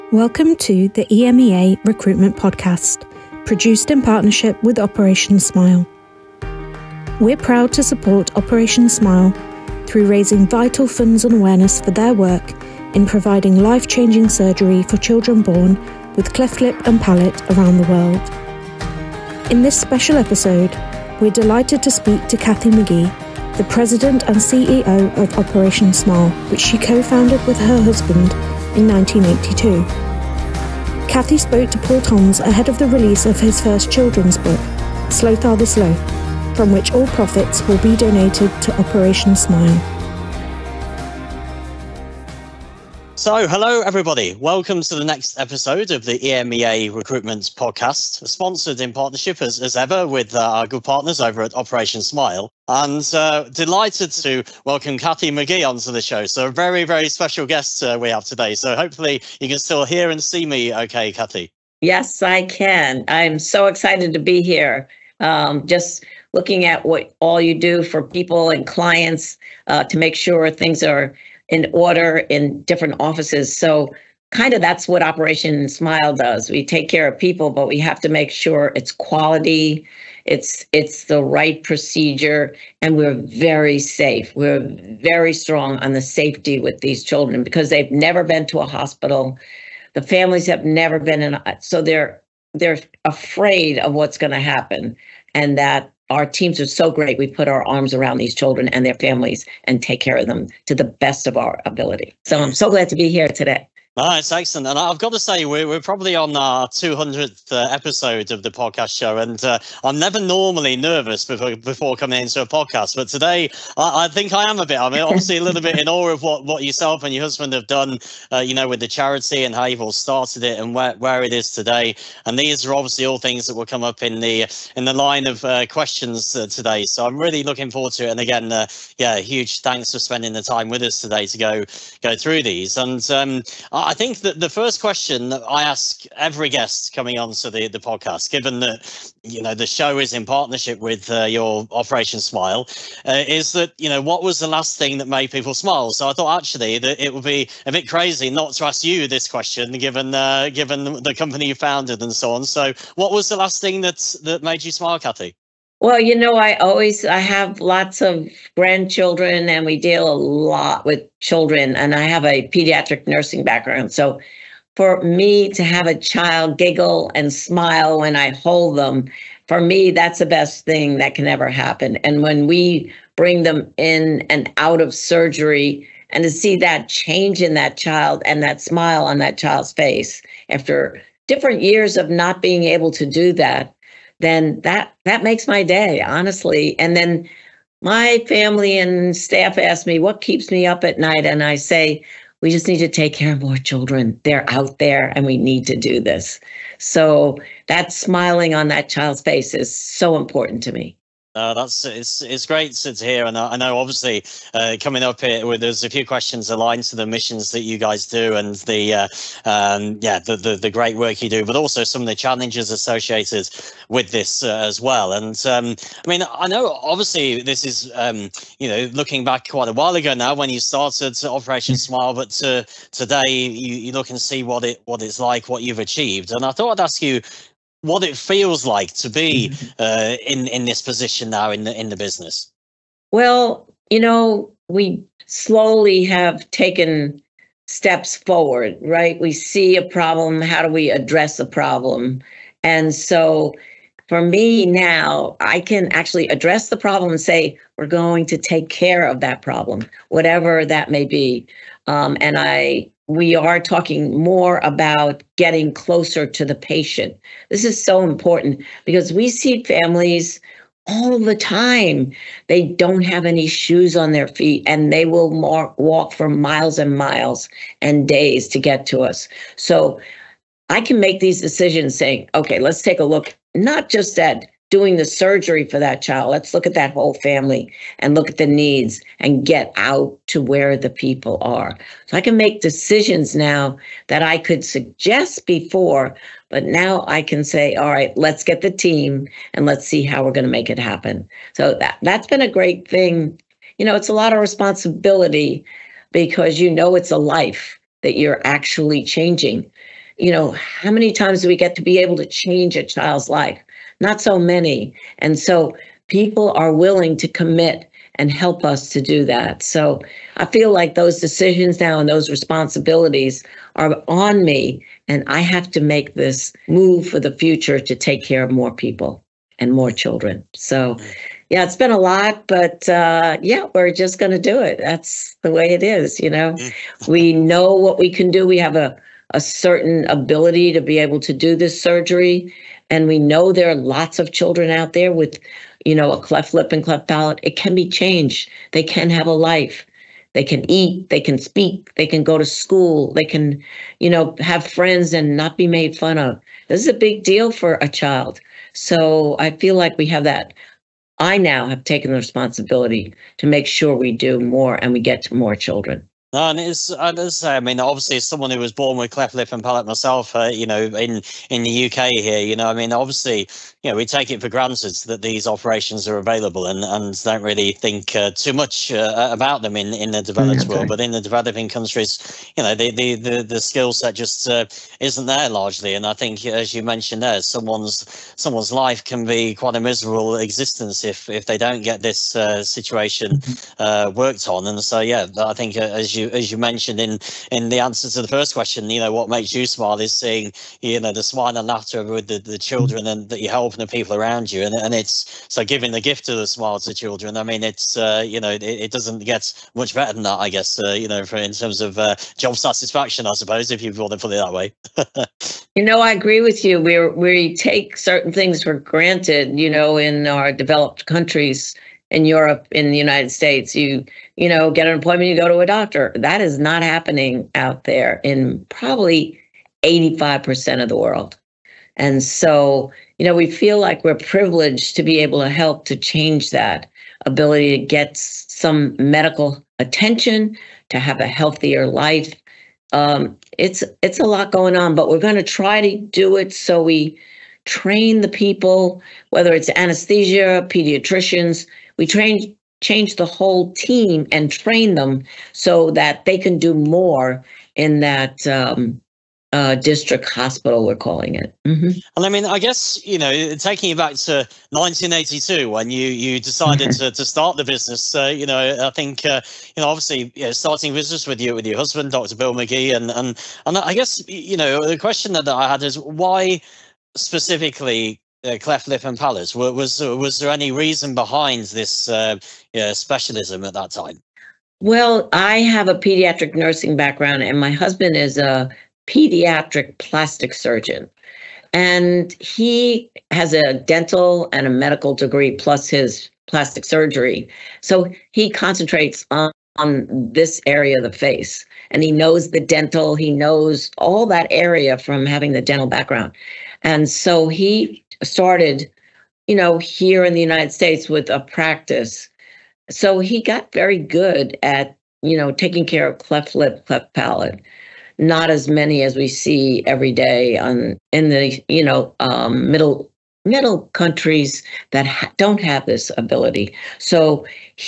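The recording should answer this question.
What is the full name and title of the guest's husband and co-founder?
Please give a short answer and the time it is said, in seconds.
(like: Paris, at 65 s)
Dr. Bill Magee, at 462 s.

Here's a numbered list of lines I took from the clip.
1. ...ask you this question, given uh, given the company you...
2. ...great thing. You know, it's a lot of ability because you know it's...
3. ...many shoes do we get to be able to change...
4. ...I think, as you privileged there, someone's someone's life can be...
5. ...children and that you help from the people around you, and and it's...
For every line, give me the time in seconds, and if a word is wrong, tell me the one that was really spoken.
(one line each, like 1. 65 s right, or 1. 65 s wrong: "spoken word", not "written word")
1. 148 s right
2. 292 s wrong: "responsibility", not "ability"
3. 300 s wrong: "times", not "shoes"
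4. 376 s wrong: "mentioned", not "privileged"
5. 392 s right.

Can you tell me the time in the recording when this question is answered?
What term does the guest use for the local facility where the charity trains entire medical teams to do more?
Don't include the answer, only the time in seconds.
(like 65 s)
449 s.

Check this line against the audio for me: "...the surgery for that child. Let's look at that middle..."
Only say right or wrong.
wrong.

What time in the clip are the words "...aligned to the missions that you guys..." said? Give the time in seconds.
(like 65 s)
206 s.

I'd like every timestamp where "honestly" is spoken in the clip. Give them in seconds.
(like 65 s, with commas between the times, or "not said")
186 s.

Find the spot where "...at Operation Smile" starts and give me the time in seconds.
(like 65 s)
51 s.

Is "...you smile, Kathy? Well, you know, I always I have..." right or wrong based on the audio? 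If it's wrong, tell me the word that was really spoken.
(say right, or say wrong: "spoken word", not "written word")
right.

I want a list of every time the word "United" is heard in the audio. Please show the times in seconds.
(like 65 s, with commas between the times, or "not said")
412 s, 500 s.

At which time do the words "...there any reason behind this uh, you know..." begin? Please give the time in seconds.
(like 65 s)
470 s.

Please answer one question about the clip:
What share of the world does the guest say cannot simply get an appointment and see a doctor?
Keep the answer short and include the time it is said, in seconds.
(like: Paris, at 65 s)
85%, at 419 s.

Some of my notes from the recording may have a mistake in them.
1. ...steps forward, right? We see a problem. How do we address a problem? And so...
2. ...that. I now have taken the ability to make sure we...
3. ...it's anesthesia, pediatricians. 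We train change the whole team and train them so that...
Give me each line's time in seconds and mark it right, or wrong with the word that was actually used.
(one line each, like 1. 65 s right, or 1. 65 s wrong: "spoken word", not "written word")
1. 237 s right
2. 350 s wrong: "responsibility", not "ability"
3. 439 s right.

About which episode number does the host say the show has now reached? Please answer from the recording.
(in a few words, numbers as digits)
200th.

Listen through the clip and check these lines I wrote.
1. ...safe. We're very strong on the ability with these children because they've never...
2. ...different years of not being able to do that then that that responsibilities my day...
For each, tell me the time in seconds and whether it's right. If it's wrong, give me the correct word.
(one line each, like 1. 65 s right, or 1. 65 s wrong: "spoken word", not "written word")
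1. 83 s wrong: "safety", not "ability"
2. 181 s wrong: "makes", not "responsibilities".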